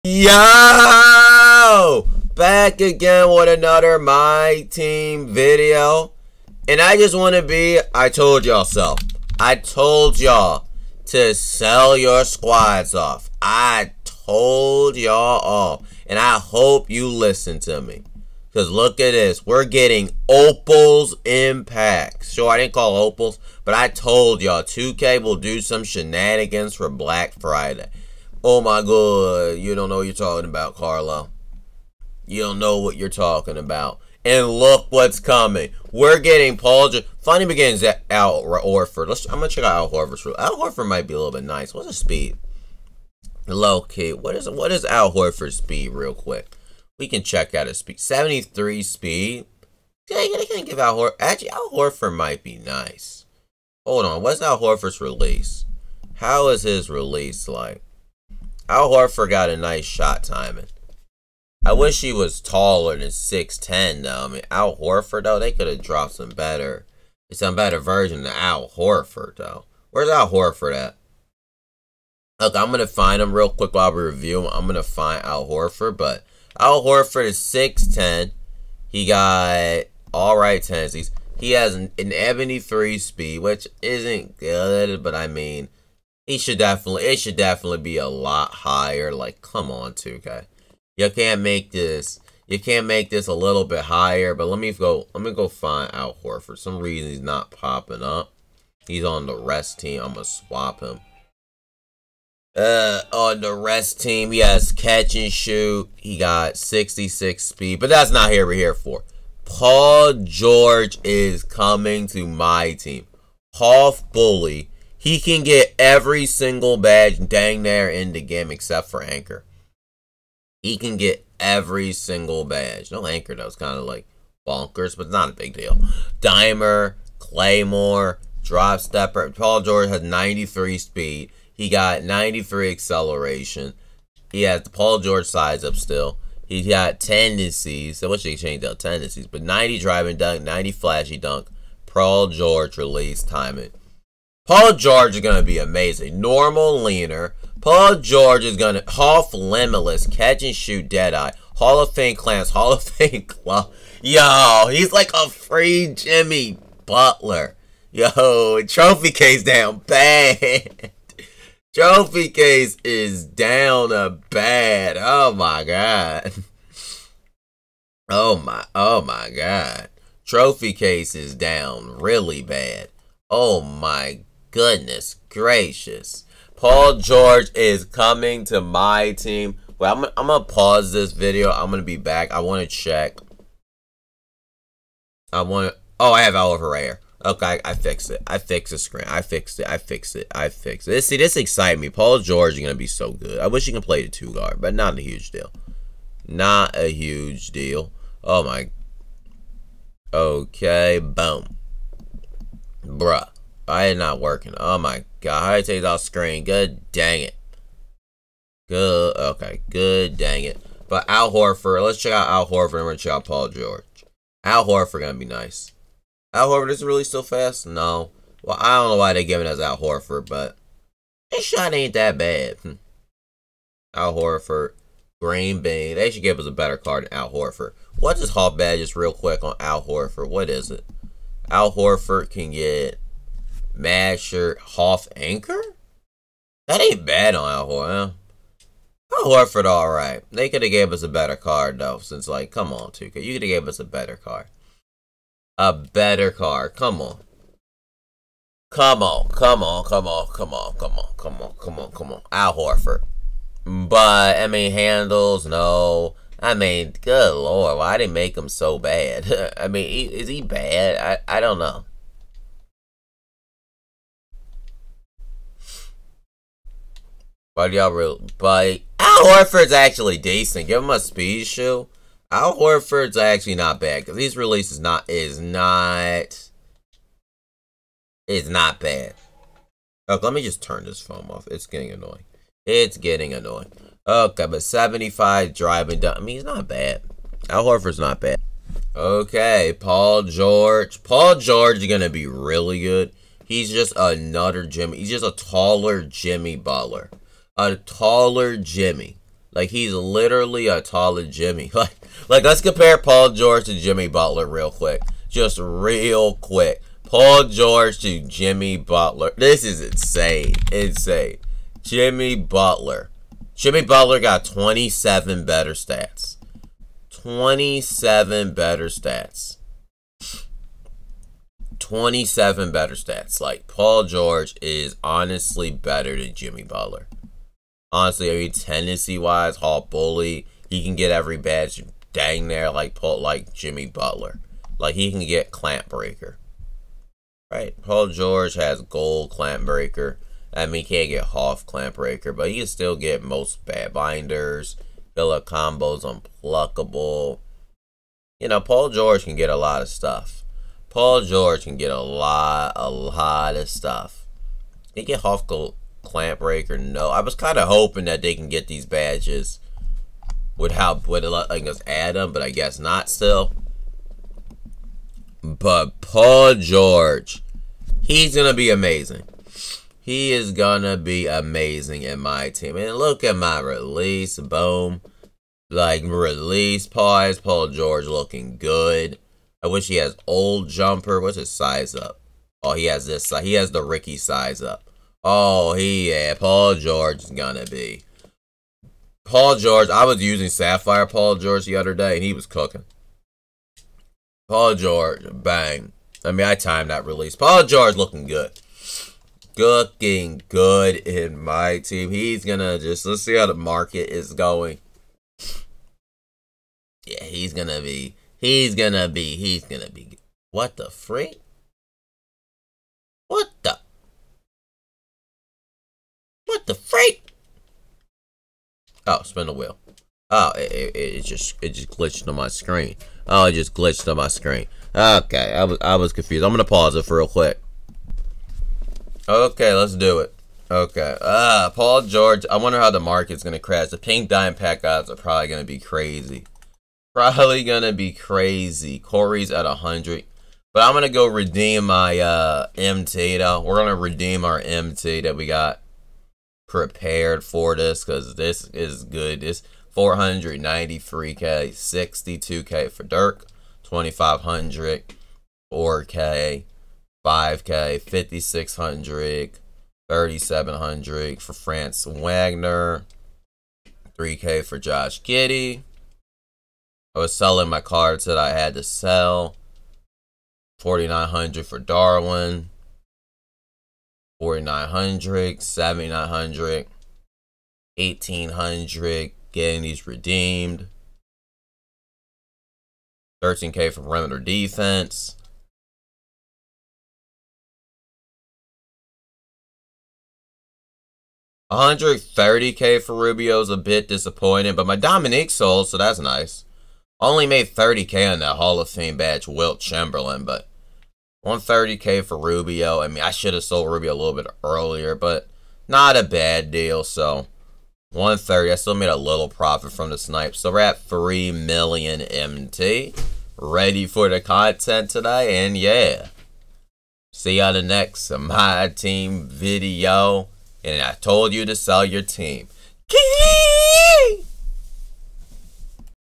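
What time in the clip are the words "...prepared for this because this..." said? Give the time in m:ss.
7:26.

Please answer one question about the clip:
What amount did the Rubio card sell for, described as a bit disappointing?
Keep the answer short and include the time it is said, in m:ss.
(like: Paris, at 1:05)
130K, at 8:11.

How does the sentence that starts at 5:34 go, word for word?
Like he can get clamp breaker.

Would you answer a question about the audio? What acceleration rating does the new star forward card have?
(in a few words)
93.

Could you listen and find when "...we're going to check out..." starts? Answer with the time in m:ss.
3:32.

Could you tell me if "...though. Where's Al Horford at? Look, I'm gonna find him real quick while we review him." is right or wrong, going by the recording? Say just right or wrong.
right.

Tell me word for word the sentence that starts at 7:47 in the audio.
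I was selling my cards that I had to sell.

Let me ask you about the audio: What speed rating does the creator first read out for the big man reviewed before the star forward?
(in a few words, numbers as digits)
73.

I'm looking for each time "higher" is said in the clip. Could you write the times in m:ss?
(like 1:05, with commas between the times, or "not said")
1:28, 1:33.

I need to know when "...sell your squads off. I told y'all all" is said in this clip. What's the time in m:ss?
0:11.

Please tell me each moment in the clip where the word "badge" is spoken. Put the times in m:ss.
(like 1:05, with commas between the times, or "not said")
1:56, 2:02, 3:48, 5:31, 5:58, 8:19.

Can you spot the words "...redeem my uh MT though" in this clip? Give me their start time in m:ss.
7:21.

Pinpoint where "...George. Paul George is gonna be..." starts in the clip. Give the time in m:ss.
4:50.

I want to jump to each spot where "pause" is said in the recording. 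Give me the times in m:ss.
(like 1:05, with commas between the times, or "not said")
3:00, 6:16, 7:06.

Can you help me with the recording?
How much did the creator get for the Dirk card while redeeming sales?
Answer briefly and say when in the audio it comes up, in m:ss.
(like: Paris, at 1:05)
62K, at 7:31.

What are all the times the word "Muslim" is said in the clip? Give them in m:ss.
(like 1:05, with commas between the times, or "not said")
not said.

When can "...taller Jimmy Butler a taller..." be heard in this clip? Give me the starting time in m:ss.
4:55.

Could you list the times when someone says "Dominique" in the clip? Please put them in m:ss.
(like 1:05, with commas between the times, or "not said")
8:14.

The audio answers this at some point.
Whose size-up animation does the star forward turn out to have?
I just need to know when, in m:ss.
6:23.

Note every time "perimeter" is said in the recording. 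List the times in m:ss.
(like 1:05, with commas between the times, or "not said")
8:04.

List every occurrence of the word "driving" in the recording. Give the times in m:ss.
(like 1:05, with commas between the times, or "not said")
2:19, 4:45.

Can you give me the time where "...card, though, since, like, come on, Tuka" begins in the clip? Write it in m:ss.
4:01.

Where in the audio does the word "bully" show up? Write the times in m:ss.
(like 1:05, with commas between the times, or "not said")
1:54, 5:29.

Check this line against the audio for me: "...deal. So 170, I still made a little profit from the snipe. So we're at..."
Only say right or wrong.
wrong.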